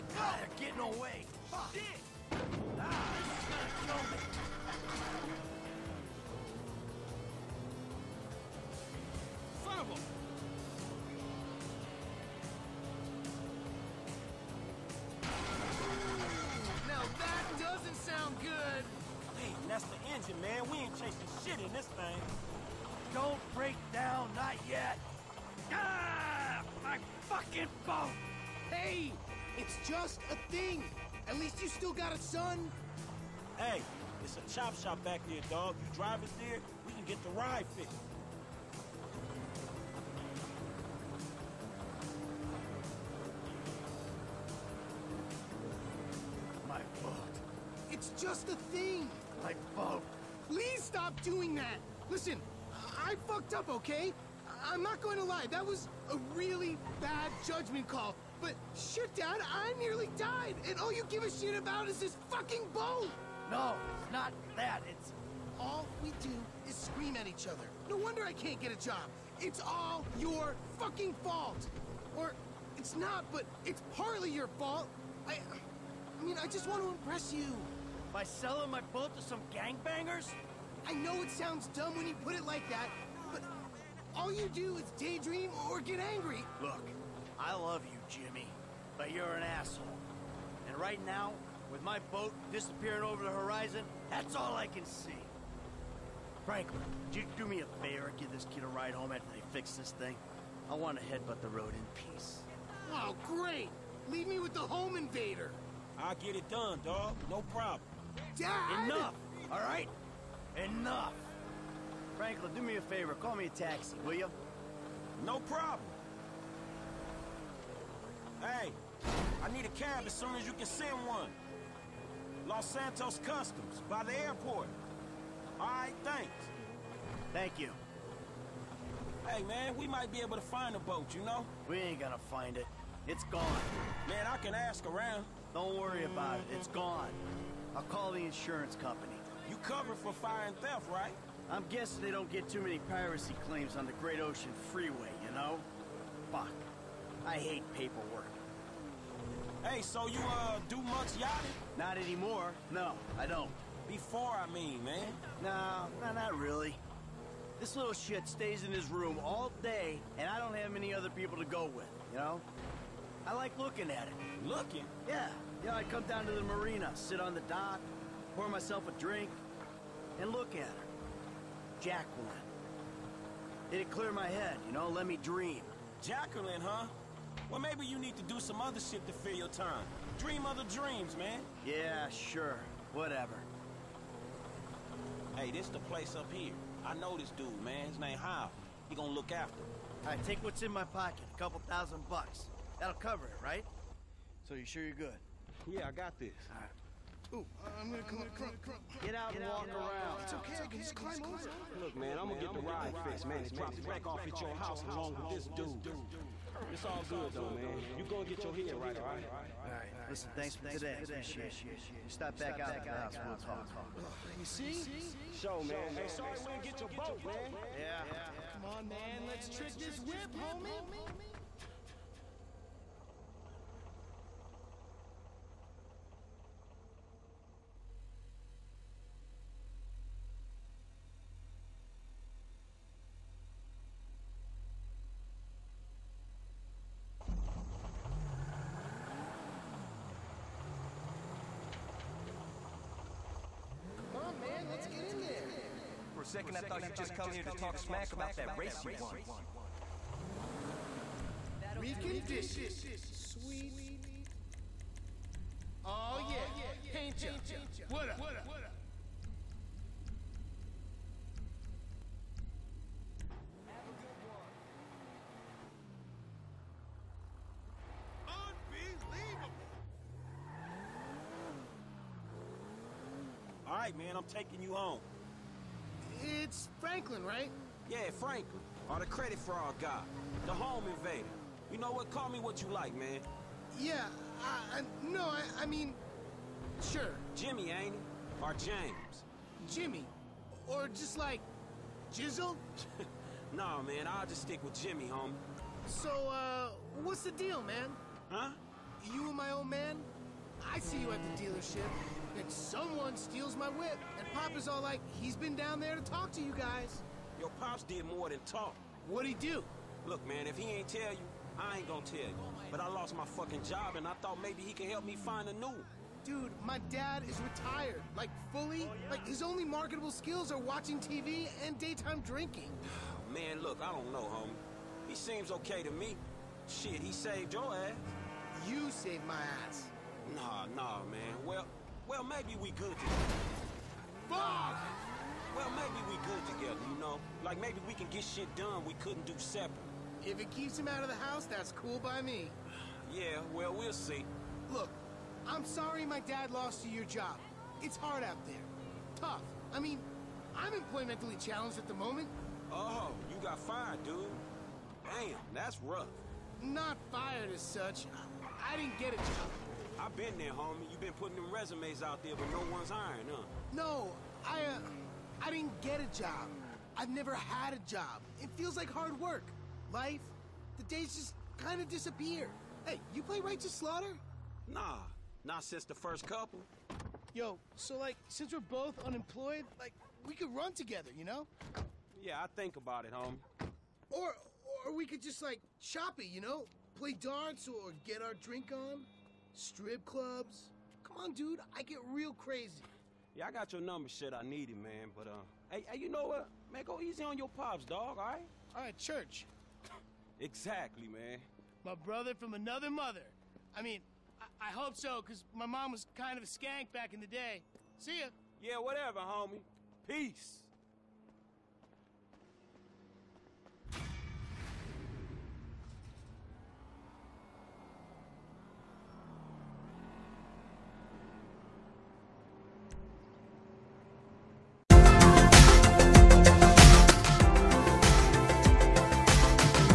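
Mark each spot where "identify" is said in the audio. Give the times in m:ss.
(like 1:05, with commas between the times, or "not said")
not said.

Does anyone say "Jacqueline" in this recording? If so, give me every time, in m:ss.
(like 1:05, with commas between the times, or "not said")
2:51, 2:56.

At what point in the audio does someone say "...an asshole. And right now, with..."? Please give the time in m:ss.
1:29.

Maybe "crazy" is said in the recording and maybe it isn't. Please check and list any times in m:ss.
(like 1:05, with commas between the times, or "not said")
6:32.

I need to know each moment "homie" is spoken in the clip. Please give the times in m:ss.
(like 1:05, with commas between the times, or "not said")
3:40, 4:55, 5:24, 6:00, 6:23, 6:49.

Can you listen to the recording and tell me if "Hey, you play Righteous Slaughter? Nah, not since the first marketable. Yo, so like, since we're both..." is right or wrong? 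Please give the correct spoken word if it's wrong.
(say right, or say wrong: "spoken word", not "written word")
wrong: "couple", not "marketable".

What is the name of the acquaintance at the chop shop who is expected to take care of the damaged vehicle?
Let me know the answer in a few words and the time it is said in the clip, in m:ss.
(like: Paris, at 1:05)
Hao, at 3:08.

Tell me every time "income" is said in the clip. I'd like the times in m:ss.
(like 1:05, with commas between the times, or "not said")
not said.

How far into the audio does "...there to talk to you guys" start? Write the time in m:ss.
5:05.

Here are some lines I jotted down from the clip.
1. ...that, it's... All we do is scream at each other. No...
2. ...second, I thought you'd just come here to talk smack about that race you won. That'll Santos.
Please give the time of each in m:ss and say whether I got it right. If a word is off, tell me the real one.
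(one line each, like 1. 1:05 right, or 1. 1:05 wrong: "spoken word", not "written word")
1. 1:04 right
2. 4:06 wrong: "Recondition", not "Santos".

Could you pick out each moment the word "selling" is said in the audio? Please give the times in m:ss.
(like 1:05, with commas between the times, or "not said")
1:18.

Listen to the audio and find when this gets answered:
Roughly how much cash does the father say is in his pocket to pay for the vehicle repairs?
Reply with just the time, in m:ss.
3:11.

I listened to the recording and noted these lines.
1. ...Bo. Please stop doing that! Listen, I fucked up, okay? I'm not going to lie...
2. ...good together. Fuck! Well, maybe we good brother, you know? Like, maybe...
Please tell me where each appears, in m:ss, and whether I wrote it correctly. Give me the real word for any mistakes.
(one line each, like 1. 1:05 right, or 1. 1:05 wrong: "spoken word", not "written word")
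1. 0:49 right
2. 5:32 wrong: "together", not "brother".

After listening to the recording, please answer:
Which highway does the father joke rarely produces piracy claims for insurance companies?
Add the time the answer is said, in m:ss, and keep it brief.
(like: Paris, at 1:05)
Great Ocean Freeway, at 2:23.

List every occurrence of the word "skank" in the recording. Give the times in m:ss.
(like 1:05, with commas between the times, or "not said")
6:46.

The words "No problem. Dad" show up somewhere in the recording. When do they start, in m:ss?
1:47.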